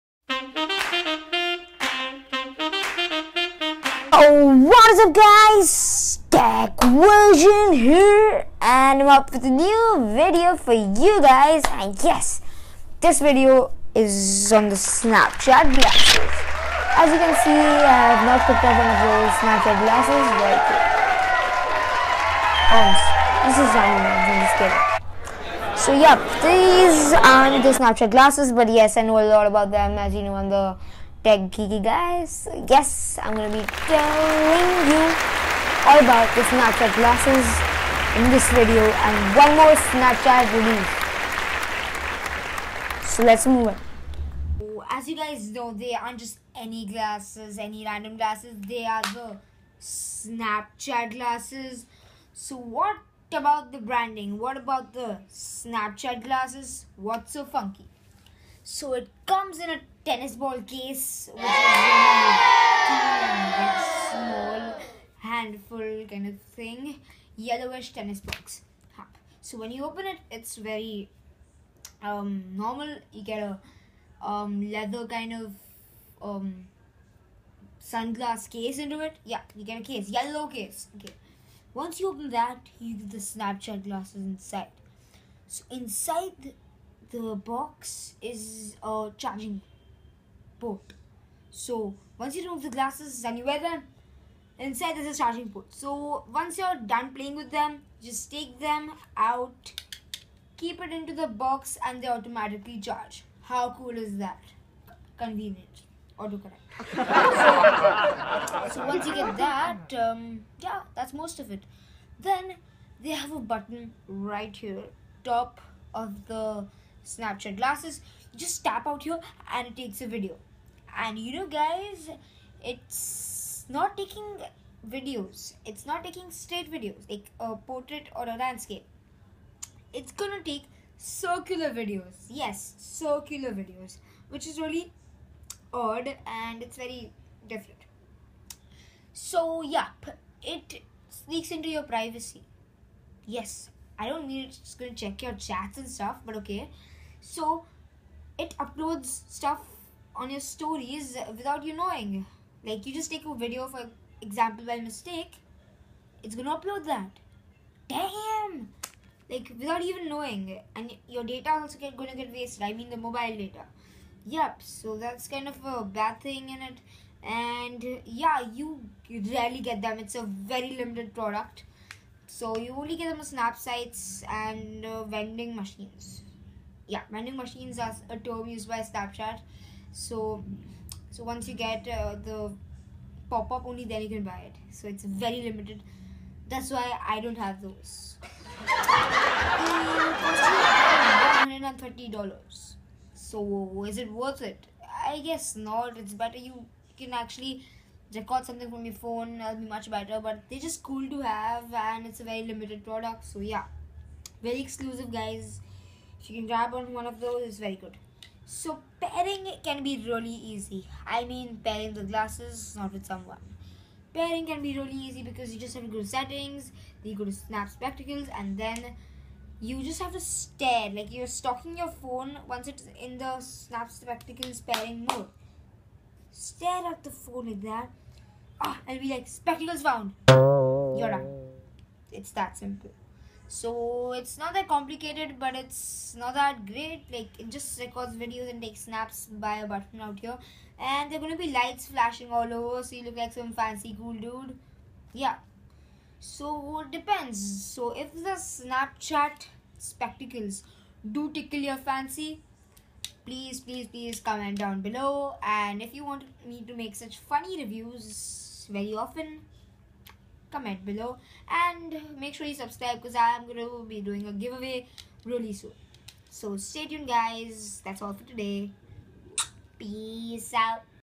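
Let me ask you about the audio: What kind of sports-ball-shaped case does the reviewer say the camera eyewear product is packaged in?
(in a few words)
tennis ball case.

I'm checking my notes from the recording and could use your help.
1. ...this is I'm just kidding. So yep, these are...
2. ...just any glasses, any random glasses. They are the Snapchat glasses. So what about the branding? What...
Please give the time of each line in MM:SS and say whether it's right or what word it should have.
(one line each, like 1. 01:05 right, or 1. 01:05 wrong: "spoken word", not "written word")
1. 00:25 right
2. 00:46 right.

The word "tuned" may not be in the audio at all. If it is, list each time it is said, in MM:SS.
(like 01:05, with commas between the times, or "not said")
04:26.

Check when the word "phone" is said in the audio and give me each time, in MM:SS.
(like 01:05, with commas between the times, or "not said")
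03:18, 03:41, 03:47.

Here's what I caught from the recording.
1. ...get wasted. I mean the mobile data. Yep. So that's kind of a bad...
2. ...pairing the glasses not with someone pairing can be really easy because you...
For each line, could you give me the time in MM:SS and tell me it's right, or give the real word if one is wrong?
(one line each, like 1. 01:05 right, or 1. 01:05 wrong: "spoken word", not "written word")
1. 02:42 right
2. 03:31 right.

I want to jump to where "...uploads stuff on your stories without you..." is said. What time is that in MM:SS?
02:28.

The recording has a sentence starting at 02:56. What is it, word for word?
Yeah, vending machines are a term used by Snapchat.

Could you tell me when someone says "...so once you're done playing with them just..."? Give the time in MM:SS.
01:35.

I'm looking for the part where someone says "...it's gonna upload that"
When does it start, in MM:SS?
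02:36.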